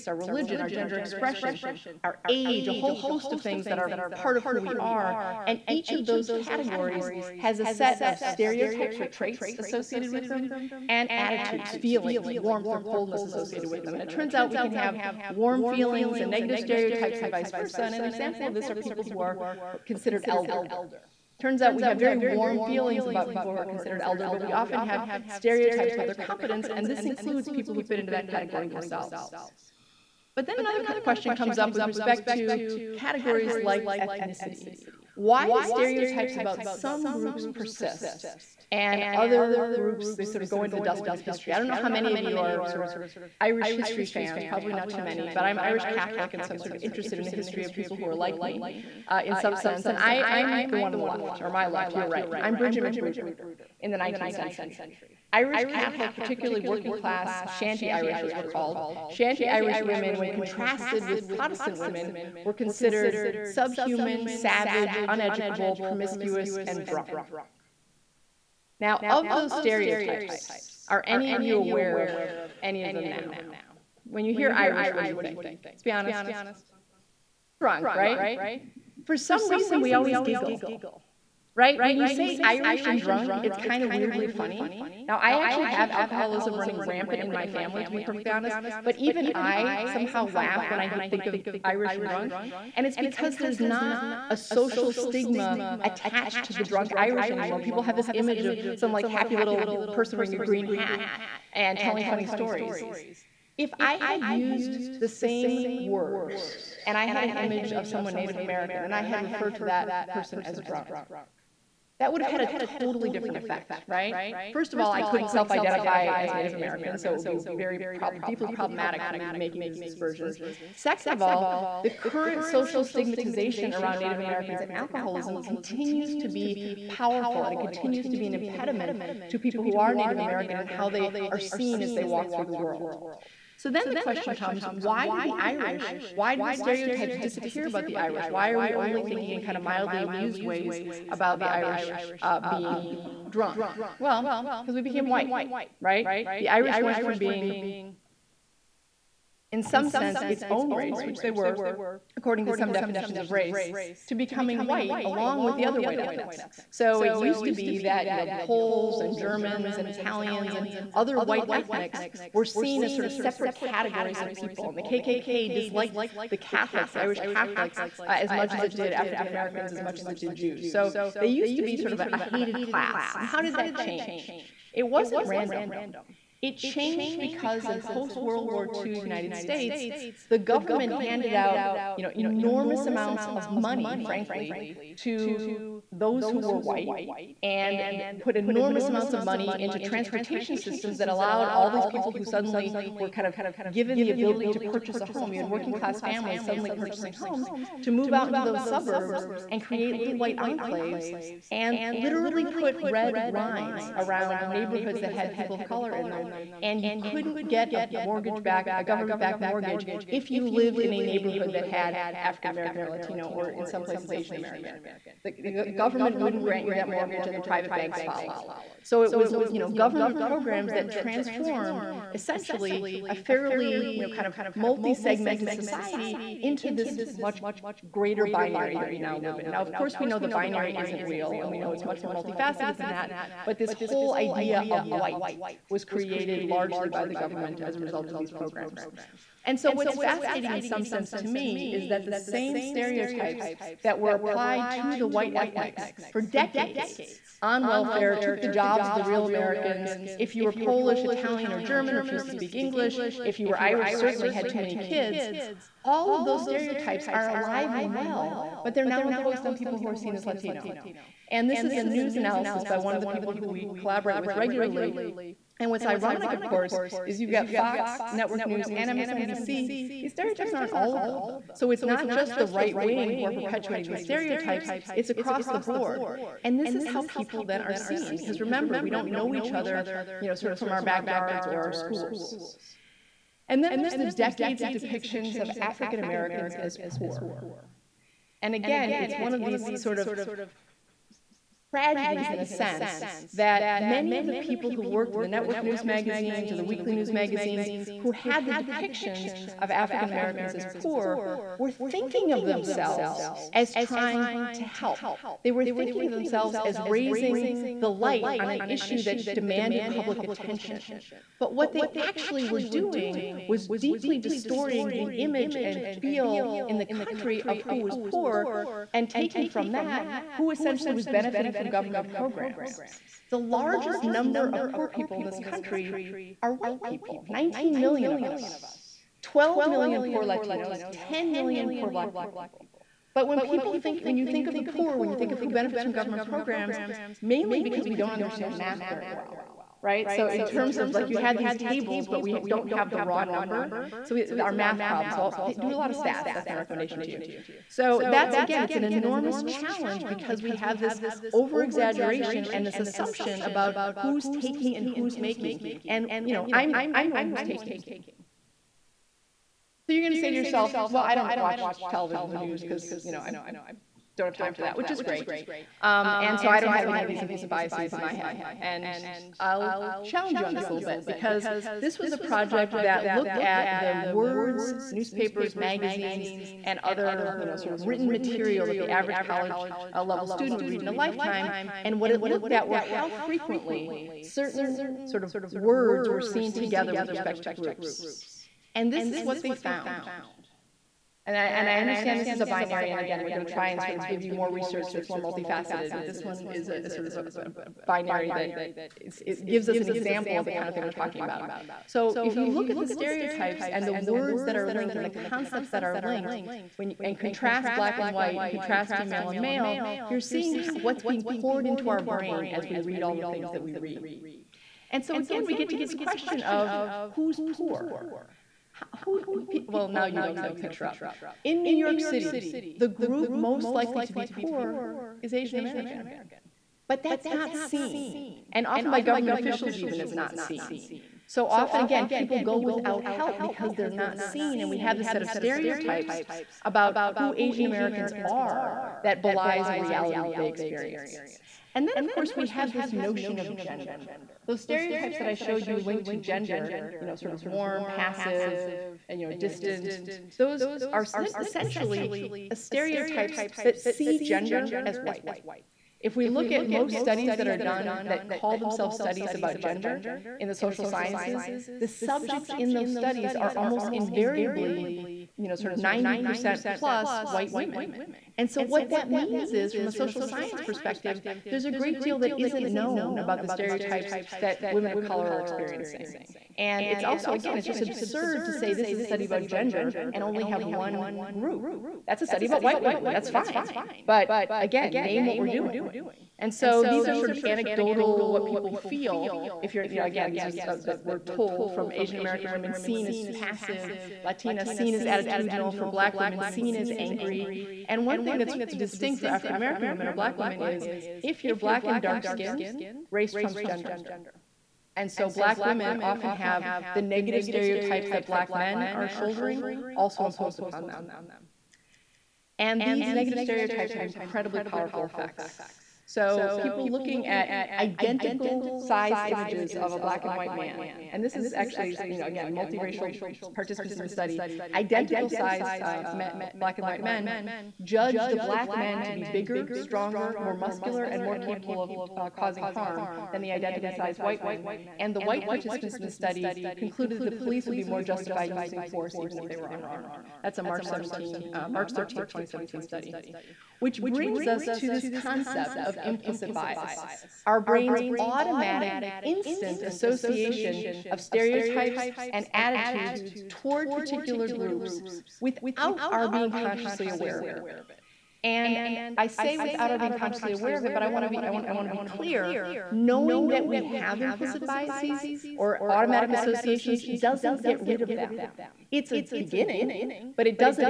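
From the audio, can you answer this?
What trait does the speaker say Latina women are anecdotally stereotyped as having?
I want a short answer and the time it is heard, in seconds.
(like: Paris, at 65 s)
attitudinal, at 495 s.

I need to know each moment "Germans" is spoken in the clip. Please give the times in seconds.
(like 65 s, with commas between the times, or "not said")
159 s, 251 s.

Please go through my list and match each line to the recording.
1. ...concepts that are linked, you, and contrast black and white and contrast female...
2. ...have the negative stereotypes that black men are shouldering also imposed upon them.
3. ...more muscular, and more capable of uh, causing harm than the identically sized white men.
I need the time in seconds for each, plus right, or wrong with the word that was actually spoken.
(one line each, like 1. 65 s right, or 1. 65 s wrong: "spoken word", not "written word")
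1. 405 s right
2. 506 s right
3. 530 s right.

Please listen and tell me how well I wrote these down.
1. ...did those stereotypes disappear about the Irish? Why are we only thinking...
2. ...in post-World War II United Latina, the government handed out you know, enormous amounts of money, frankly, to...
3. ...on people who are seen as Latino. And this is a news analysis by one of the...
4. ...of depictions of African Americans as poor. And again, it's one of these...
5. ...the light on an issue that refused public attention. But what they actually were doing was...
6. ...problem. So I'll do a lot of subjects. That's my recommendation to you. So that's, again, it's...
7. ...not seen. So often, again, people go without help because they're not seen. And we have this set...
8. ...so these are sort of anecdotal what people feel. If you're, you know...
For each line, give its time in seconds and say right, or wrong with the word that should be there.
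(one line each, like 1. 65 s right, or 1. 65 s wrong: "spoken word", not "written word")
1. 136 s right
2. 177 s wrong: "States", not "Latina"
3. 259 s right
4. 284 s right
5. 307 s wrong: "demanded", not "refused"
6. 344 s wrong: "stats", not "subjects"
7. 430 s right
8. 486 s right.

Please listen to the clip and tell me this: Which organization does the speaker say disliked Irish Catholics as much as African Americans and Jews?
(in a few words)
KKK.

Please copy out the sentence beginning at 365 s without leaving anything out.
Um, and so I don't have any of these implicit biases in my head.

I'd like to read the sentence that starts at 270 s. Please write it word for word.
These stereotypes aren't all of them.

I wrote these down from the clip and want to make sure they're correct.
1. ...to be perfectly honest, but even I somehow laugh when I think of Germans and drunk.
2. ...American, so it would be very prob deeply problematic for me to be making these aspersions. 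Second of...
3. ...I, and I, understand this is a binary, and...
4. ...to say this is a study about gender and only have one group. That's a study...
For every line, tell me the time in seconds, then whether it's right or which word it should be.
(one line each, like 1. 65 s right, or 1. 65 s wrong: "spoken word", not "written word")
1. 87 s wrong: "Irish", not "Germans"
2. 116 s right
3. 391 s right
4. 478 s right.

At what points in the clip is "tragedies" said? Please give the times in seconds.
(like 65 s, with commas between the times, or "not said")
291 s.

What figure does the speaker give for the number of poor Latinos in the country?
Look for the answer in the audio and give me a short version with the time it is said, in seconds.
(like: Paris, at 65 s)
12 million, at 329 s.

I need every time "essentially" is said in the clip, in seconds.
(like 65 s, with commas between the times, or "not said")
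222 s, 320 s, 451 s.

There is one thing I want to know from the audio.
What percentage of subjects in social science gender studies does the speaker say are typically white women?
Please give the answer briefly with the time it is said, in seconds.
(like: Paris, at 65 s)
90%, at 465 s.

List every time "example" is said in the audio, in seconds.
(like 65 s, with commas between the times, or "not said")
18 s, 399 s.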